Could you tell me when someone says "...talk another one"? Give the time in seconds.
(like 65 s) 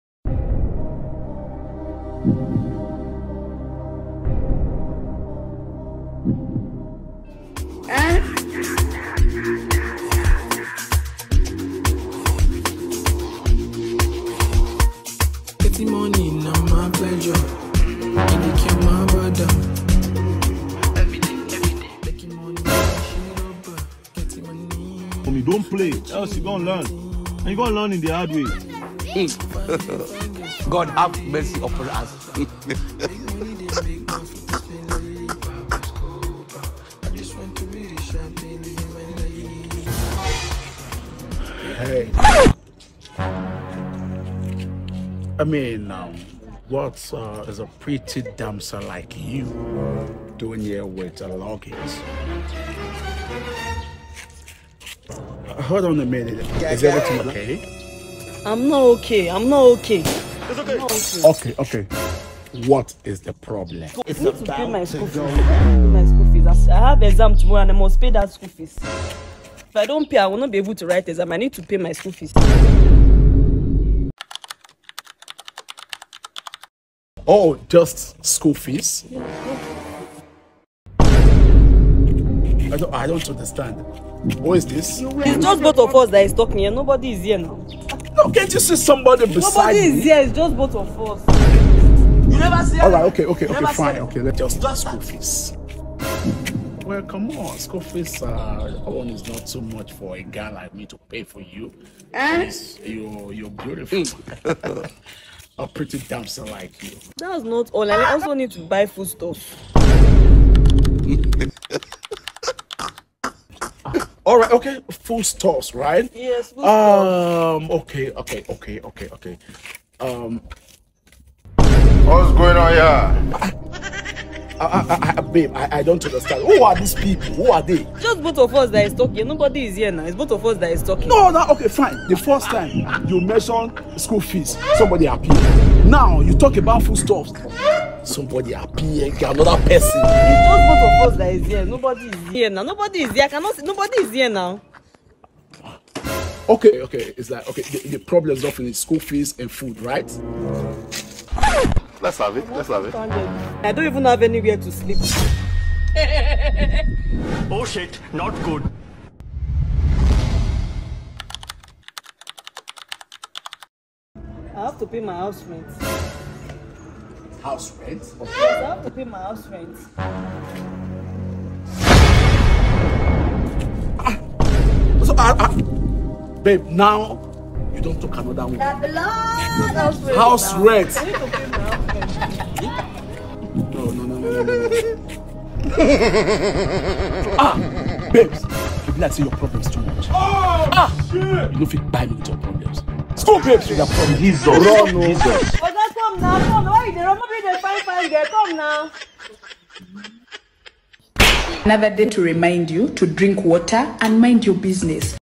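178 s.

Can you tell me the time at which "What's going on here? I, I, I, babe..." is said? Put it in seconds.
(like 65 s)
121 s.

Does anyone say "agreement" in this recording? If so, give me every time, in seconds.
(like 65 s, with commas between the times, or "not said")
not said.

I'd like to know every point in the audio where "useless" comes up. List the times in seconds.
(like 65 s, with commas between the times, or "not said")
not said.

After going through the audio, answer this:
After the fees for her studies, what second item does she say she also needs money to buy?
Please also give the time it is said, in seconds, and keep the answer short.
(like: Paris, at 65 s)
food stuff, at 108 s.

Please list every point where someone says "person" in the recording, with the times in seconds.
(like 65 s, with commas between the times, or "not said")
139 s.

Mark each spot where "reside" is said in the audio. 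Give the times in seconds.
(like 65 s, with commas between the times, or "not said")
not said.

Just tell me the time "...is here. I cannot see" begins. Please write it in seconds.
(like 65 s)
143 s.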